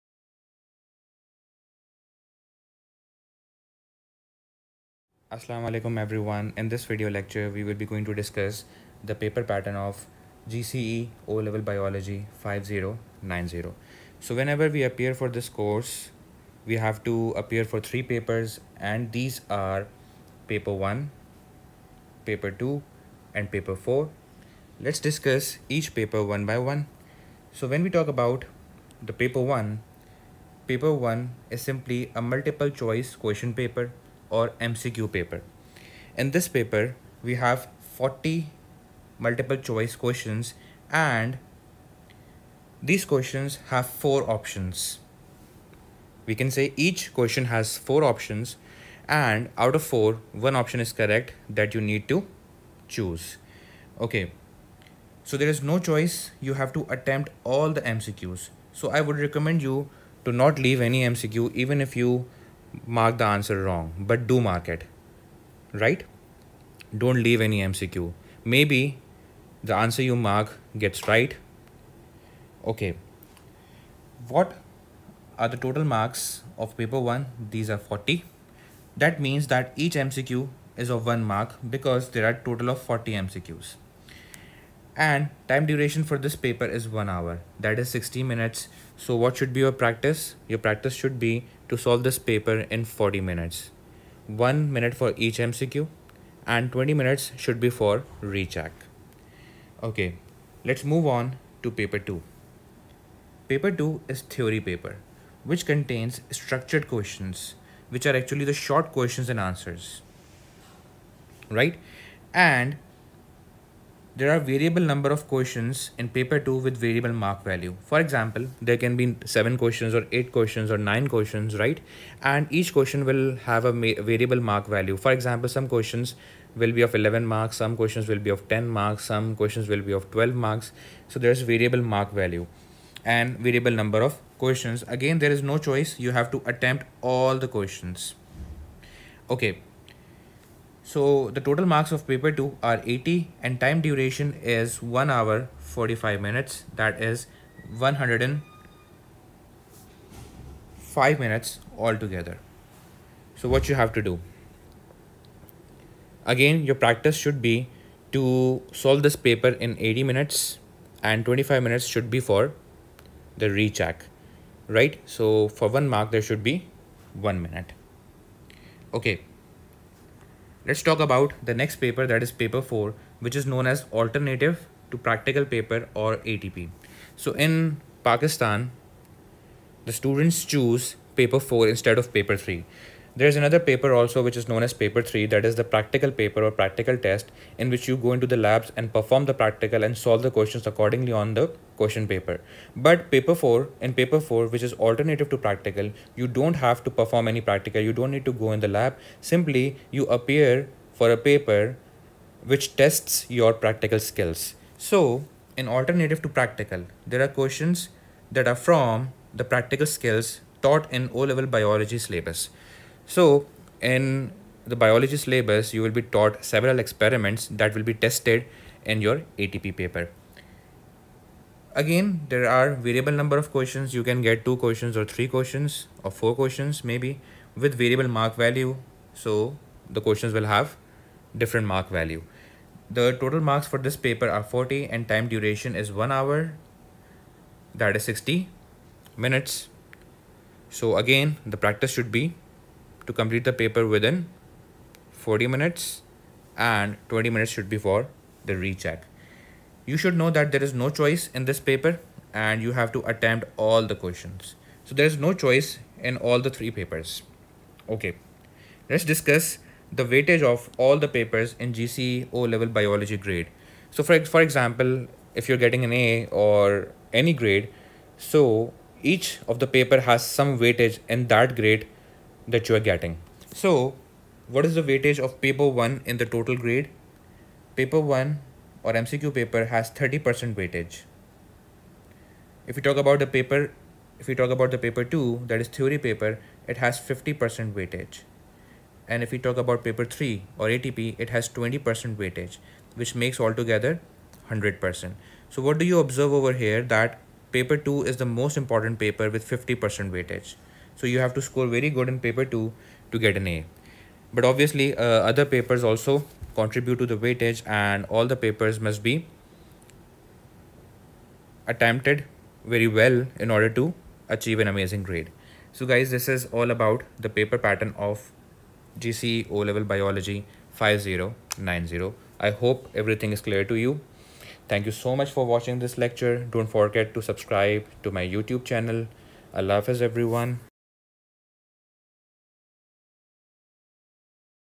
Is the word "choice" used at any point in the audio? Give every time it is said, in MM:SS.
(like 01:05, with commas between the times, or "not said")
00:32, 00:39, 00:55, 02:15, 04:10, 04:15.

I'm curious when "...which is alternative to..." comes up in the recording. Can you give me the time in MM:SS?
03:14.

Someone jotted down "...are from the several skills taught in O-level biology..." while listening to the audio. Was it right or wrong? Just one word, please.
wrong.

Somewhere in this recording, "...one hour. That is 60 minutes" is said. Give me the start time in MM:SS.
03:55.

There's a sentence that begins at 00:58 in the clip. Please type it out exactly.
So I would recommend you to not leave any MCQ even if you mark the answer wrong, but do mark it.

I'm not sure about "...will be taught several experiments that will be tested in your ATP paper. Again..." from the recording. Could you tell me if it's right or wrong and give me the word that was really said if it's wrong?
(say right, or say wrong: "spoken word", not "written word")
right.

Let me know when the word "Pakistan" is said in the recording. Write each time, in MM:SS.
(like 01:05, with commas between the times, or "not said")
02:58.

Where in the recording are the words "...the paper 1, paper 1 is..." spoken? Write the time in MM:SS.
00:29.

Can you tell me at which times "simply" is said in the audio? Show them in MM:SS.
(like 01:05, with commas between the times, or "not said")
00:31, 03:19.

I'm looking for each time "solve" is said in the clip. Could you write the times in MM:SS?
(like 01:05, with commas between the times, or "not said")
01:31, 02:38, 03:09.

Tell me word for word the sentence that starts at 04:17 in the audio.
Okay, let's discuss the weightage of all the papers in GCE O level biology grade.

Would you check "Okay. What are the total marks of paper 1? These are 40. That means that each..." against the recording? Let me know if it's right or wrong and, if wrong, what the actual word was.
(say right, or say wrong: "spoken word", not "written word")
right.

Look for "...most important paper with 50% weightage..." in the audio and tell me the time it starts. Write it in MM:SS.
04:58.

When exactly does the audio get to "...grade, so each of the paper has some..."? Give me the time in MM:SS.
04:27.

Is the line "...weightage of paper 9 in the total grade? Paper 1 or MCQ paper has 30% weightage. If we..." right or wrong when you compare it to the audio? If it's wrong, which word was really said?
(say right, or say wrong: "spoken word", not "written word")
wrong: "1", not "9".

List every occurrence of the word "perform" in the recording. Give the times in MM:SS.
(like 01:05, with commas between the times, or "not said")
03:08, 03:16.